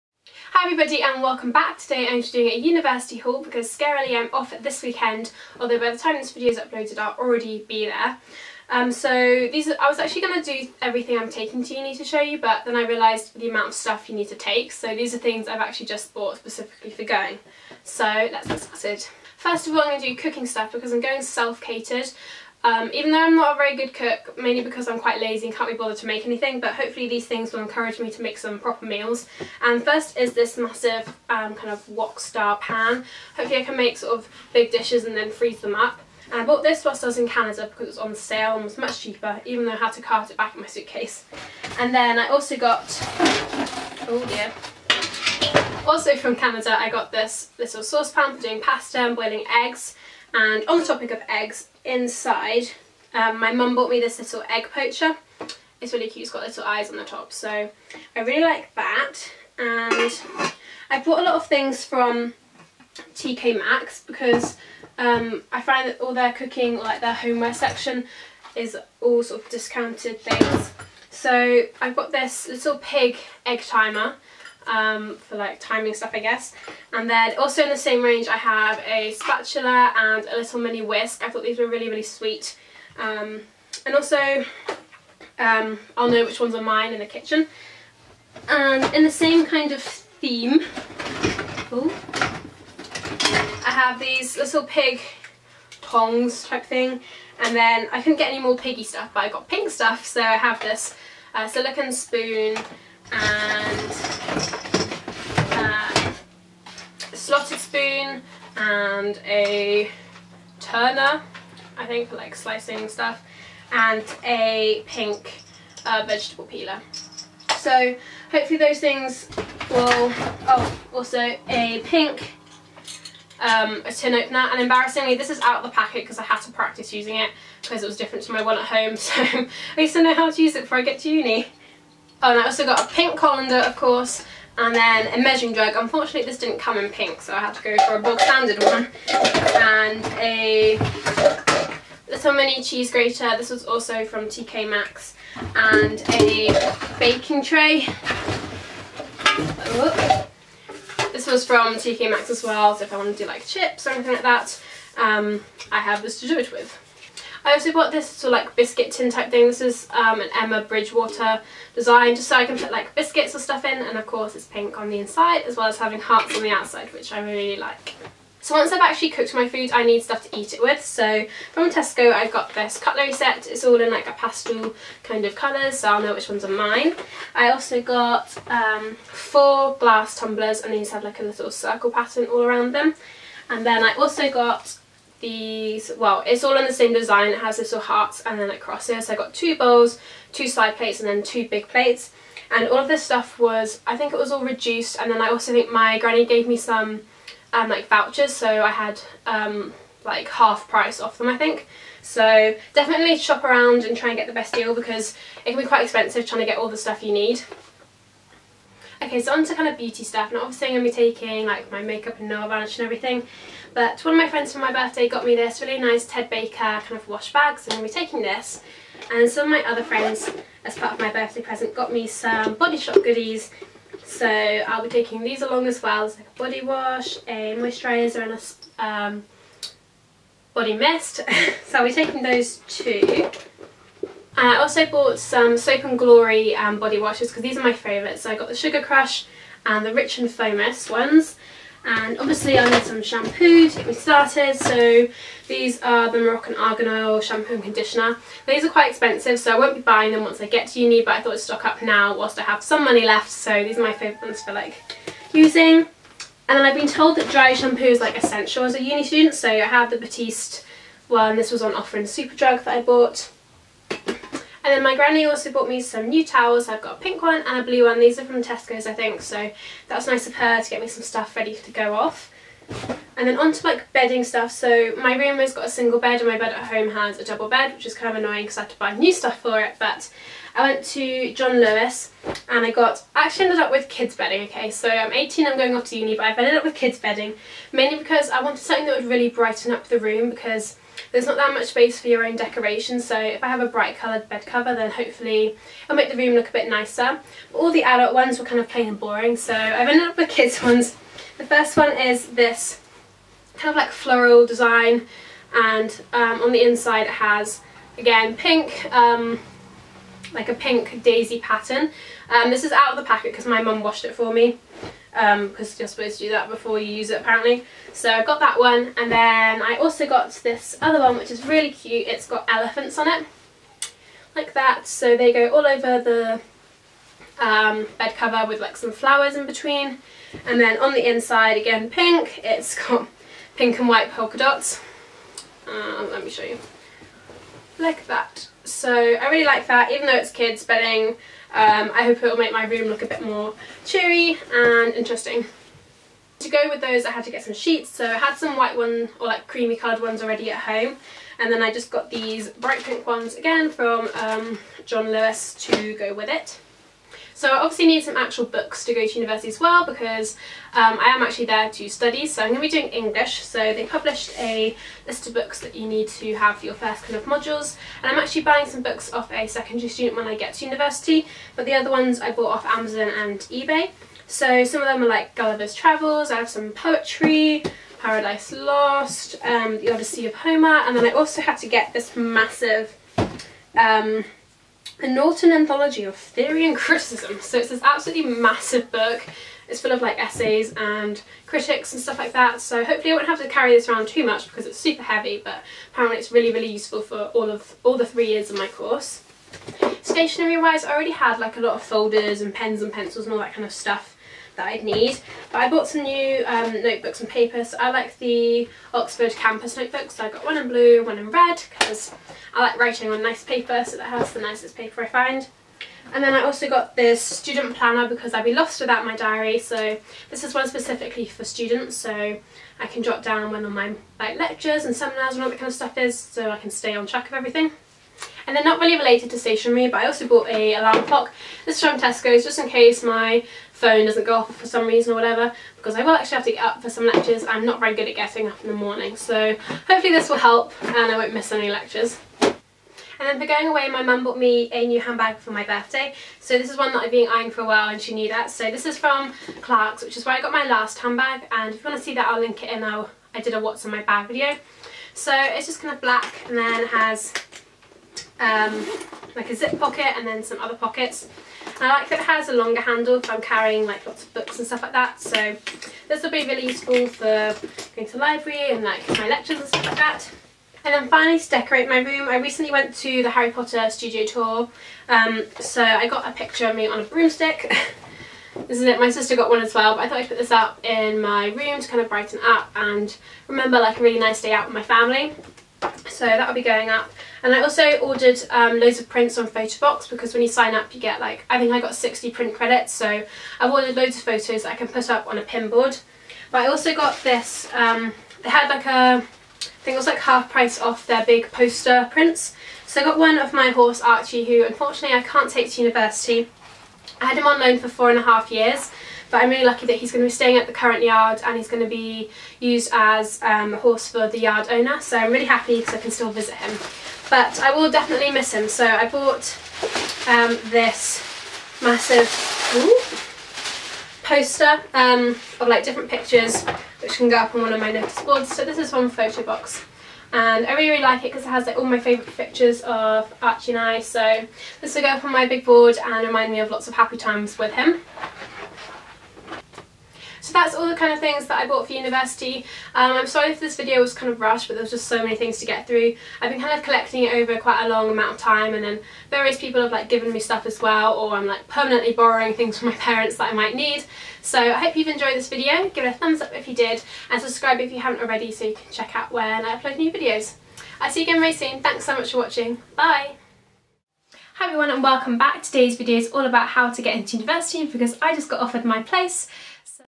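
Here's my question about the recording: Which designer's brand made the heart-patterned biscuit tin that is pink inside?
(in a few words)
Emma Bridgewater.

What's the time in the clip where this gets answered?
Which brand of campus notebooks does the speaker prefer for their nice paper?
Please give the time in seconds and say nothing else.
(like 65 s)
408 s.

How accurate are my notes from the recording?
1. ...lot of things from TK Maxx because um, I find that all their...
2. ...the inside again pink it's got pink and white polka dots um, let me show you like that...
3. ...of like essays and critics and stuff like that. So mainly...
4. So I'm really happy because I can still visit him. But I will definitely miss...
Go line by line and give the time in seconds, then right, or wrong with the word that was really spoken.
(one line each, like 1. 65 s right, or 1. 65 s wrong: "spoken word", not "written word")
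1. 61 s right
2. 330 s right
3. 389 s wrong: "hopefully", not "mainly"
4. 514 s right.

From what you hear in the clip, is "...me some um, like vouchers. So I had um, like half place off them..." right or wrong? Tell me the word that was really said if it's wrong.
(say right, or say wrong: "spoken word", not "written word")
wrong: "price", not "place".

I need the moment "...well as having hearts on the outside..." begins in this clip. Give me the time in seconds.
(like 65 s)
165 s.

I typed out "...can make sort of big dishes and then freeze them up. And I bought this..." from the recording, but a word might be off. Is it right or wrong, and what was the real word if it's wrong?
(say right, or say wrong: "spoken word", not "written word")
right.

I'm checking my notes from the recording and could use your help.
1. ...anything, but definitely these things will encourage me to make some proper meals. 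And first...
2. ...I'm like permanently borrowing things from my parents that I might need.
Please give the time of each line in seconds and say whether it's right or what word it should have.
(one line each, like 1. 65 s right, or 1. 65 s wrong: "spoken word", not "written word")
1. 26 s wrong: "hopefully", not "definitely"
2. 551 s right.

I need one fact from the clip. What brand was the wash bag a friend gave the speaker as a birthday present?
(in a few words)
Ted Baker.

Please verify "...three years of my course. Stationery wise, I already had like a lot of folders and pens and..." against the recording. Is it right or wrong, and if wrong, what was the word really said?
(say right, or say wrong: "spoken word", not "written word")
right.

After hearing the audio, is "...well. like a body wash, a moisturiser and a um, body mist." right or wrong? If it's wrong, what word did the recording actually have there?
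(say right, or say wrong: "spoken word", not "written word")
right.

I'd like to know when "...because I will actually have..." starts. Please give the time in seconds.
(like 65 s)
435 s.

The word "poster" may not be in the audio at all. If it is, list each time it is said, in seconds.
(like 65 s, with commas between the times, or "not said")
501 s, 524 s.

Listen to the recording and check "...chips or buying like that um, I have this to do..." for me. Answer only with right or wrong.
wrong.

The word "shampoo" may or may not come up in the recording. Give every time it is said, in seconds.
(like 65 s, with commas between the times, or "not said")
243 s, 247 s, 257 s.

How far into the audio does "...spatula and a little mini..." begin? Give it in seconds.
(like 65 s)
79 s.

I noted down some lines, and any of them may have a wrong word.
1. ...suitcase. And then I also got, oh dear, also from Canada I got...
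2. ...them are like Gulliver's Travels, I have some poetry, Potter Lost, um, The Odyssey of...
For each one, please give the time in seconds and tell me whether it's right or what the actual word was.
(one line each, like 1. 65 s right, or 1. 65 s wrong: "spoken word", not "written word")
1. 40 s right
2. 374 s wrong: "Paradise", not "Potter".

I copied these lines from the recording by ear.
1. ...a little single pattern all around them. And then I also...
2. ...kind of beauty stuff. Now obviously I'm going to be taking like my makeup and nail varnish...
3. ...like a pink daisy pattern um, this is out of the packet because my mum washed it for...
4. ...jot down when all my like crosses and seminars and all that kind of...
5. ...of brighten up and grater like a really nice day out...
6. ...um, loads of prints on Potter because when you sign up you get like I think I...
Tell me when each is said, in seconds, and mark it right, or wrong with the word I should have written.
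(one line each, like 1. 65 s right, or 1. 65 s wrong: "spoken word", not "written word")
1. 181 s wrong: "circle", not "single"
2. 209 s right
3. 310 s right
4. 423 s wrong: "lectures", not "crosses"
5. 482 s wrong: "remember", not "grater"
6. 488 s wrong: "Photobox", not "Potter".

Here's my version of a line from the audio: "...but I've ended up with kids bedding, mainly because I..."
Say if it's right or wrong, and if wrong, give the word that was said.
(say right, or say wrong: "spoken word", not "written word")
right.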